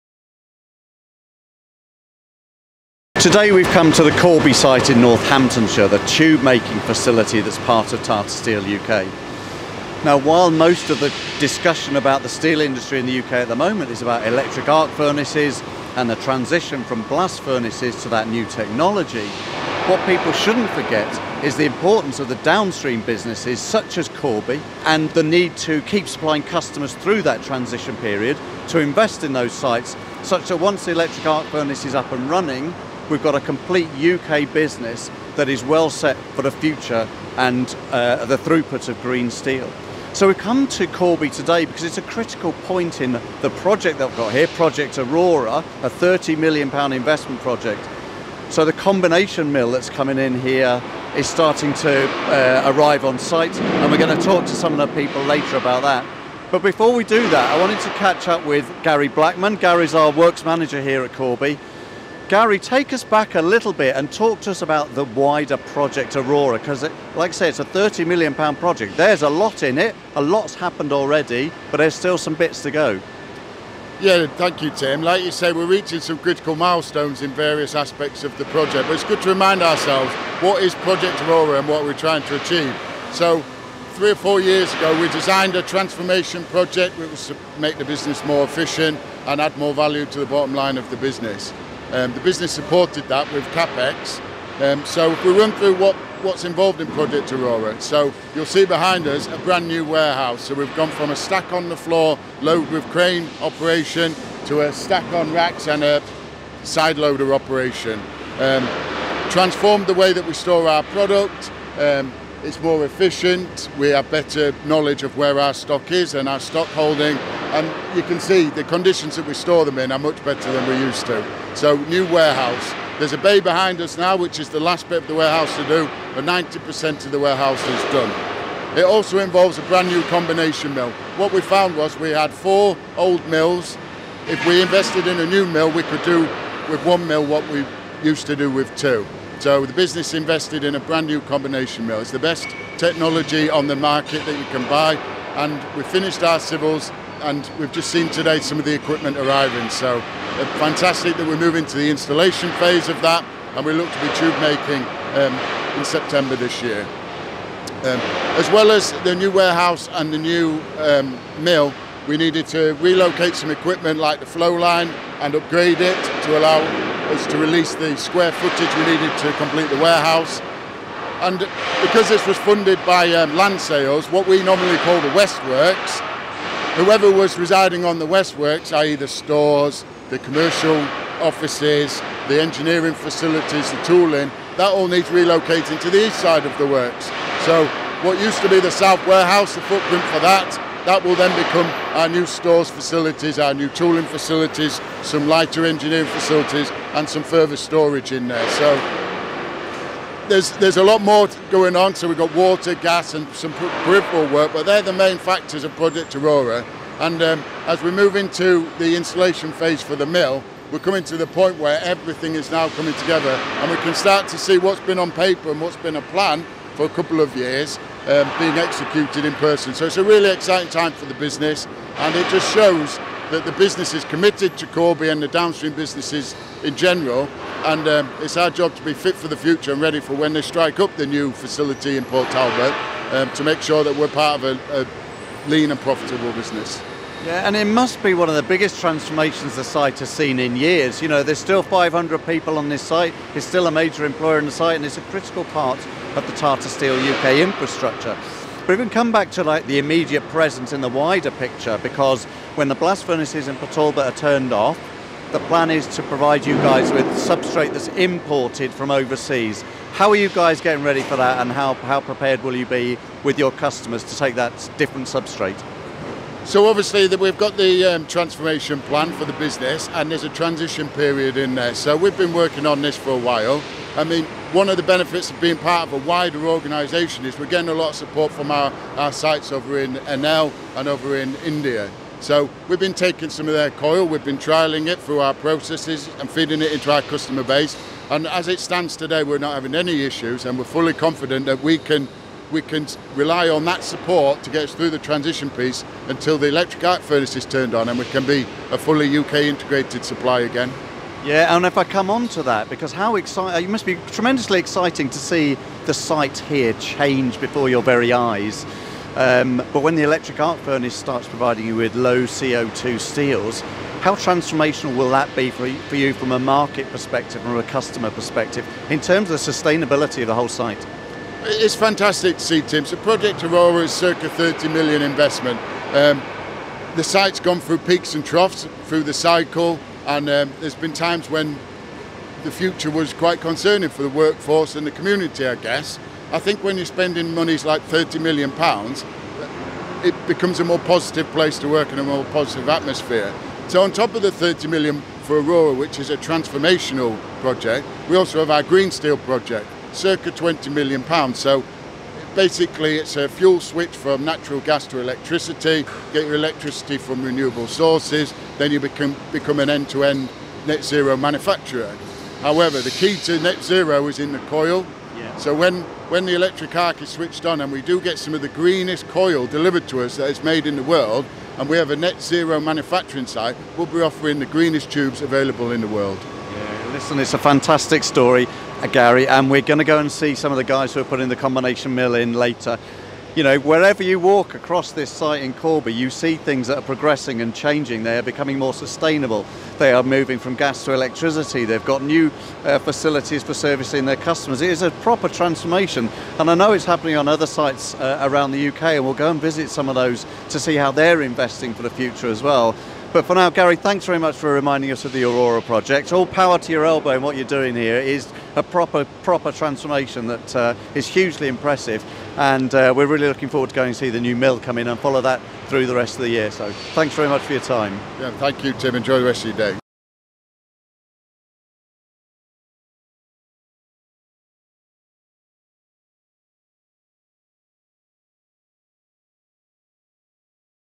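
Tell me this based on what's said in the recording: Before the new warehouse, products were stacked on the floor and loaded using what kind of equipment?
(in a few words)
Crane.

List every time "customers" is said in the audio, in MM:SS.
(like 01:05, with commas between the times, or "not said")
00:26, 04:23, 04:47, 05:17, 06:34.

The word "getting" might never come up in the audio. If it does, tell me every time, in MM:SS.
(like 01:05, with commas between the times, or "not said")
04:20, 04:37.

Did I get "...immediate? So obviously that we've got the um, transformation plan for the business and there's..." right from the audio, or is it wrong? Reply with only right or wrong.
wrong.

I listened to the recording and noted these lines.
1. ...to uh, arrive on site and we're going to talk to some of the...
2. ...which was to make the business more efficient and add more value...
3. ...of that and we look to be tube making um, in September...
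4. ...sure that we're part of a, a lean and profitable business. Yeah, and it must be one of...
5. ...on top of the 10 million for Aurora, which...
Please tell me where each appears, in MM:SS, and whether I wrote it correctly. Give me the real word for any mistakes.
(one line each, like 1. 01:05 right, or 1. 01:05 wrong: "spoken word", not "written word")
1. 00:51 right
2. 01:26 right
3. 02:32 right
4. 03:53 right
5. 05:43 wrong: "30", not "10".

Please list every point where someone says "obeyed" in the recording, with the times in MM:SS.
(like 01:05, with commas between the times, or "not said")
not said.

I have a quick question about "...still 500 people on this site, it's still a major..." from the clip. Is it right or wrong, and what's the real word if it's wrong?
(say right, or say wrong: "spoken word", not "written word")
right.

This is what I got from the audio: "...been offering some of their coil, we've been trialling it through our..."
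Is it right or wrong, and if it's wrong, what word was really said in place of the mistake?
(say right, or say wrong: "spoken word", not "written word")
wrong: "taking", not "offering".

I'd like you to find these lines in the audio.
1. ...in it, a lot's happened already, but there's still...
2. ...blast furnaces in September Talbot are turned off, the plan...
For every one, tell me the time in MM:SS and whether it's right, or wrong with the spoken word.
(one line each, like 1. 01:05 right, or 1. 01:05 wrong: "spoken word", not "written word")
1. 01:09 right
2. 04:12 wrong: "Port", not "September".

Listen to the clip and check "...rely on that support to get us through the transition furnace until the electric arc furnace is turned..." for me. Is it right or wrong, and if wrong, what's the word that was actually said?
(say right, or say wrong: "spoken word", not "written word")
wrong: "piece", not "furnace".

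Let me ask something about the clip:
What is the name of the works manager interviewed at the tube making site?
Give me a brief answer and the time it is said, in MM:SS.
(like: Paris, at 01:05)
Gary Blackman, at 00:58.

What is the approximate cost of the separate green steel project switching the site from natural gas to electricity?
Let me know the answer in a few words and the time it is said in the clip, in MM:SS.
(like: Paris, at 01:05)
20 million pounds, at 05:50.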